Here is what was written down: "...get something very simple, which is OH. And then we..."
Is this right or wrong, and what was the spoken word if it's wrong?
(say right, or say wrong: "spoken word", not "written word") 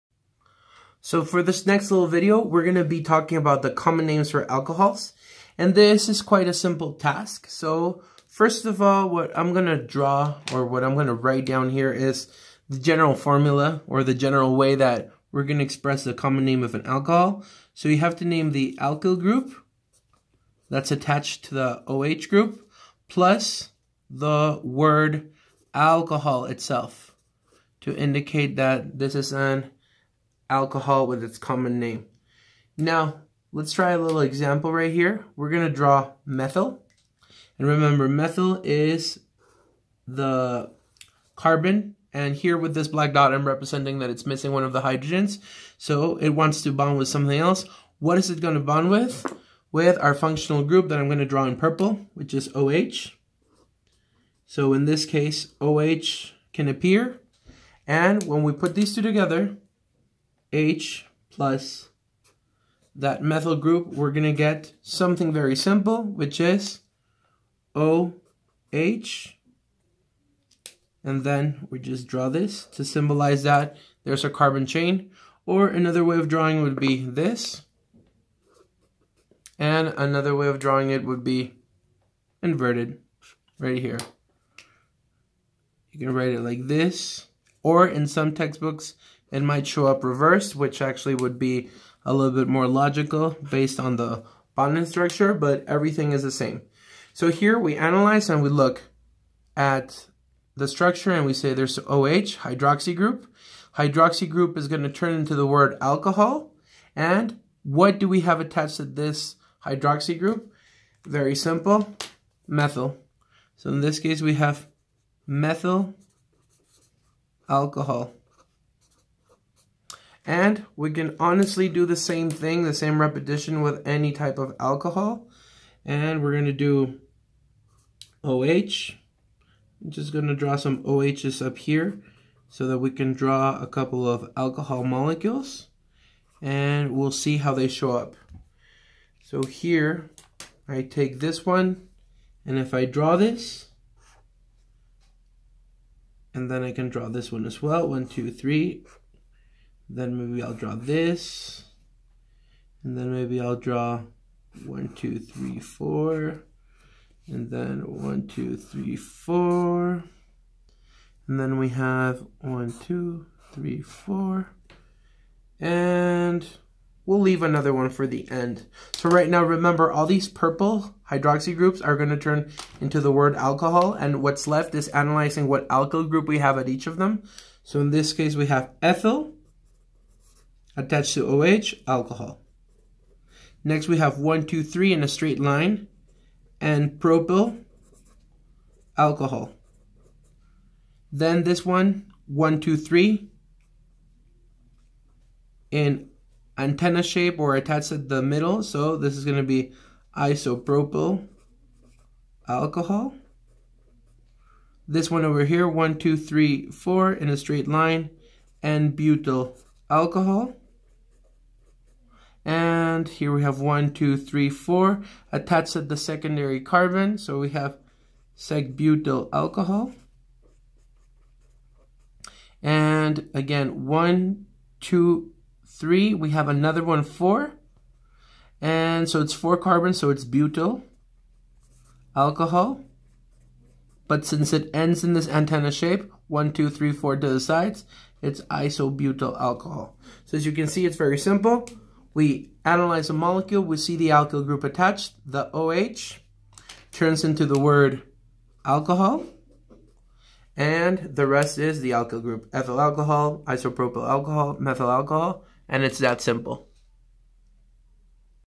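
right.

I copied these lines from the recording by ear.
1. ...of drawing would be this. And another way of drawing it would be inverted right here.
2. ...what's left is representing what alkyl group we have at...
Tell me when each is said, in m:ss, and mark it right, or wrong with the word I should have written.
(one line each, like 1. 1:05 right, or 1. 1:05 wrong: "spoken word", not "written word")
1. 1:16 right
2. 2:54 wrong: "analyzing", not "representing".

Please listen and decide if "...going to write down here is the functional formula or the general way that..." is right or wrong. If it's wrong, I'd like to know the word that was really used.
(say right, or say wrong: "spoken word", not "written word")
wrong: "general", not "functional".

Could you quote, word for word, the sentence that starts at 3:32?
And here we have one, two, three, four attached at the secondary carbon.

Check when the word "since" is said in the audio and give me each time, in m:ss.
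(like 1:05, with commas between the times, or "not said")
3:54.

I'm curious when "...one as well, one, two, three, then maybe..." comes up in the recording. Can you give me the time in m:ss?
2:27.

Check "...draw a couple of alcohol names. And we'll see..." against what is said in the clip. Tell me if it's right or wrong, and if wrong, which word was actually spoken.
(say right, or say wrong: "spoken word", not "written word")
wrong: "molecules", not "names".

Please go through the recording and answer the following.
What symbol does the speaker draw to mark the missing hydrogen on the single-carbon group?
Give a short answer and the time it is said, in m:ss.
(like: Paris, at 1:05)
black dot, at 0:42.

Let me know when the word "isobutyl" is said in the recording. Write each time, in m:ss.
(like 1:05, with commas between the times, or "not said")
3:58.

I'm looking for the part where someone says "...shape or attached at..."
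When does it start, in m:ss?
3:17.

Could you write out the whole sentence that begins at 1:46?
And what do we have attached to this hydroxy group?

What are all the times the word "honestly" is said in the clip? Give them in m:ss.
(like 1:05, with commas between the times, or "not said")
2:01.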